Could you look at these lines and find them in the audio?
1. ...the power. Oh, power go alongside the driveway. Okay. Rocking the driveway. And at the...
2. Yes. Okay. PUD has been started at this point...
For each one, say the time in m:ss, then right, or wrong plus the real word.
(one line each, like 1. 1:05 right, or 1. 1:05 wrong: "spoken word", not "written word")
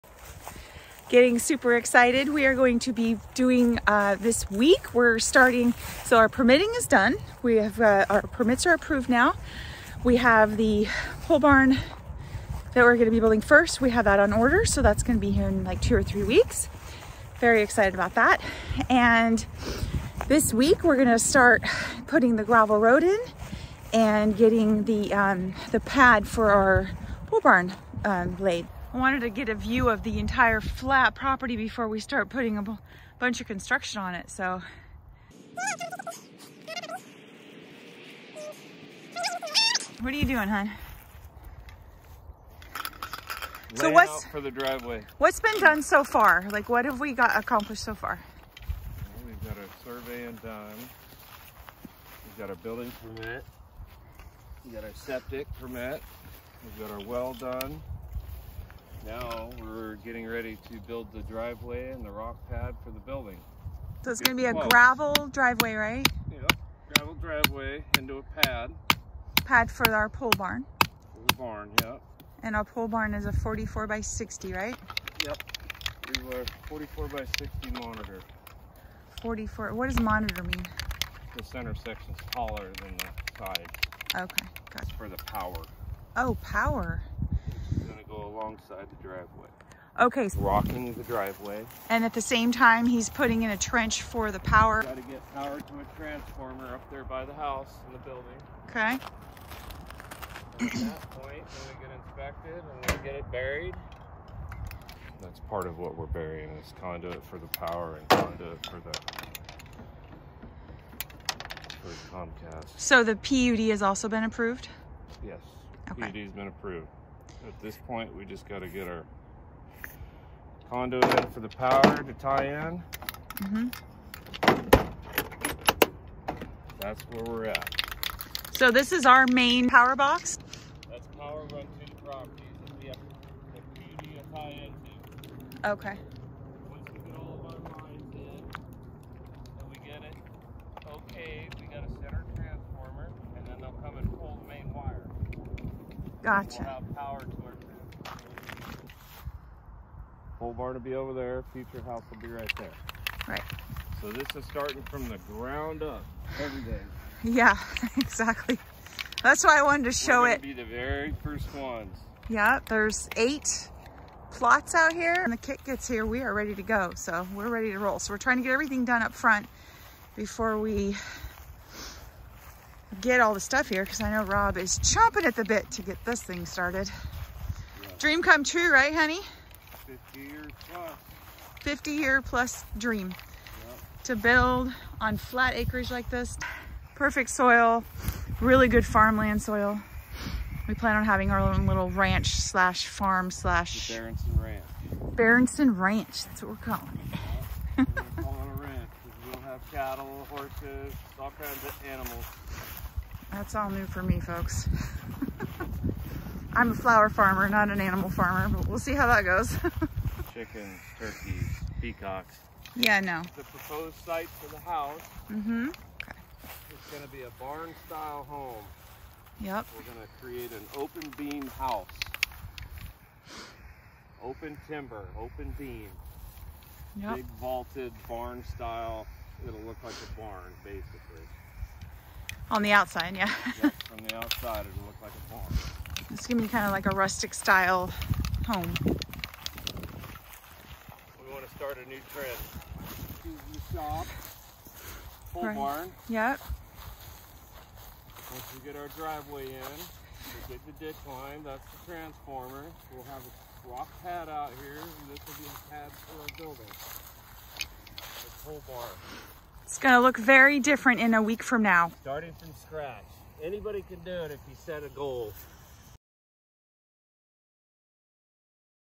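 1. 1:25 right
2. 1:55 wrong: "approved", not "started".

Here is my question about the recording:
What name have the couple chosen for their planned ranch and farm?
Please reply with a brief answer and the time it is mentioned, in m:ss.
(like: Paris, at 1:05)
Berenson Ranch, at 3:15.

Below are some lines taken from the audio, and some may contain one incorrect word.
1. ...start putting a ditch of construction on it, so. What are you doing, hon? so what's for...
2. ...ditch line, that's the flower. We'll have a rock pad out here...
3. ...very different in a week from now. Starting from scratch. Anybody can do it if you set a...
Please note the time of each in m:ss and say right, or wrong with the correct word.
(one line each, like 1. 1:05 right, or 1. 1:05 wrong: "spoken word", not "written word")
1. 0:32 wrong: "bunch", not "ditch"
2. 4:10 wrong: "transformer", not "flower"
3. 4:20 right.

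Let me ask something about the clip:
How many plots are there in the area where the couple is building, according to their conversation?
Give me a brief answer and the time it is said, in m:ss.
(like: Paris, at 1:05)
8, at 2:43.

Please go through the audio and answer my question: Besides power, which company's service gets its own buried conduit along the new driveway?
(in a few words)
Comcast.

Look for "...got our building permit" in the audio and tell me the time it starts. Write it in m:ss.
0:52.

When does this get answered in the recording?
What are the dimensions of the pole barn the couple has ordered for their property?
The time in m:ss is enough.
1:13.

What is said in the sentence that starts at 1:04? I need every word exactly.
So it's going to be a gravel driveway, right?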